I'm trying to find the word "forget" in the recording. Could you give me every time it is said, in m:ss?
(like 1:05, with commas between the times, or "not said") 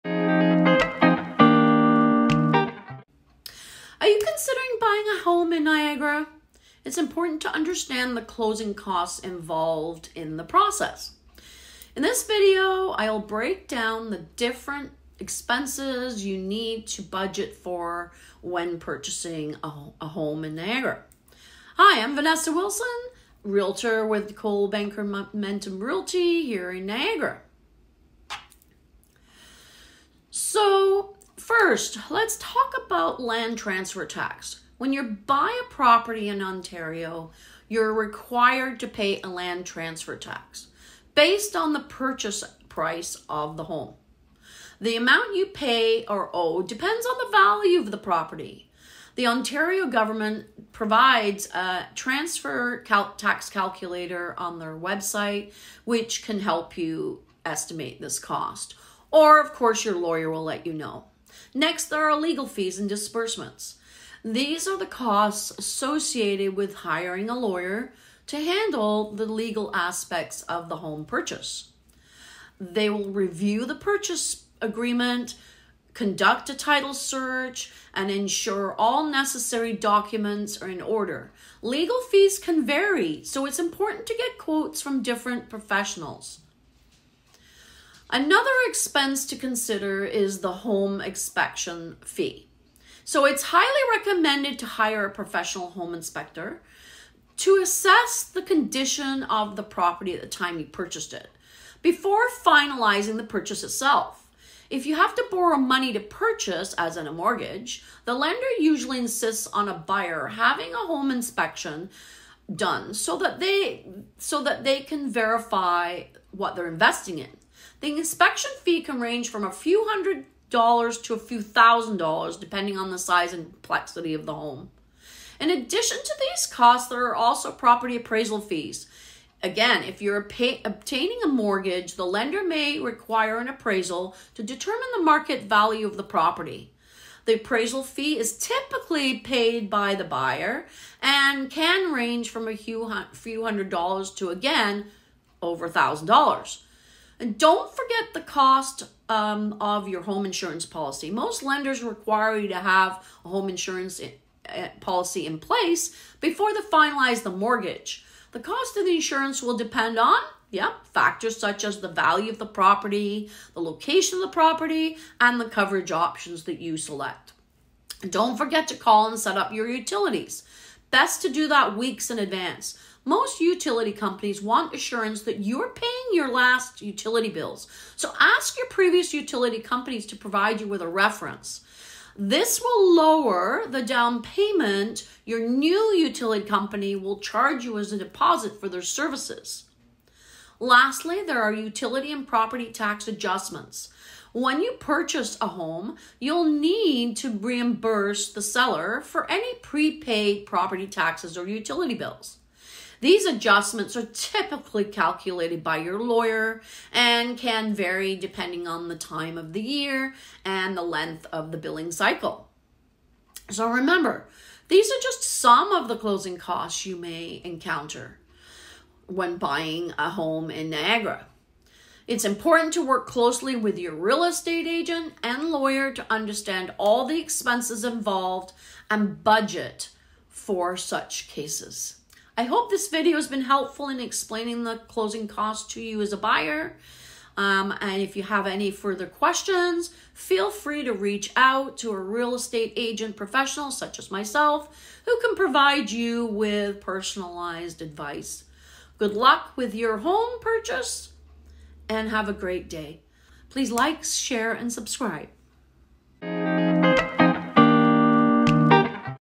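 2:27, 2:48.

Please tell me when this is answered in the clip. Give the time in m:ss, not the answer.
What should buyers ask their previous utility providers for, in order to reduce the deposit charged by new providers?
3:00.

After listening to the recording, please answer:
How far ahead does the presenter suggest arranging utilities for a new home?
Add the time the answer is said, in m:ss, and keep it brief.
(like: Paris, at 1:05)
Weeks in advance, at 2:51.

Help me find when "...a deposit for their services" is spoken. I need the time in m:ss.
3:07.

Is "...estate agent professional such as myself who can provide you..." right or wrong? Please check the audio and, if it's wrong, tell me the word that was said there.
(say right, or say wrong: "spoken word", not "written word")
right.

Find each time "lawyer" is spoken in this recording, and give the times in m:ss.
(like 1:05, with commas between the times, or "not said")
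0:59, 1:07, 3:25, 3:45.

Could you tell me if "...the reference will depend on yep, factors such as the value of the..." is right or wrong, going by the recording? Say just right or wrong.
wrong.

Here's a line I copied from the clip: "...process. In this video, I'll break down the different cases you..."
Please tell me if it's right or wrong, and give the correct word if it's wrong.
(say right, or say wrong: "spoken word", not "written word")
wrong: "expenses", not "cases".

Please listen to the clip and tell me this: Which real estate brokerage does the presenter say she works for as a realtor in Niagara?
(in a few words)
Coldwell Banker Momentum Realty.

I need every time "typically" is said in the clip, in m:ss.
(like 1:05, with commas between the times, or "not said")
2:18, 3:24.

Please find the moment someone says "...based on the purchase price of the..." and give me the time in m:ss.
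0:41.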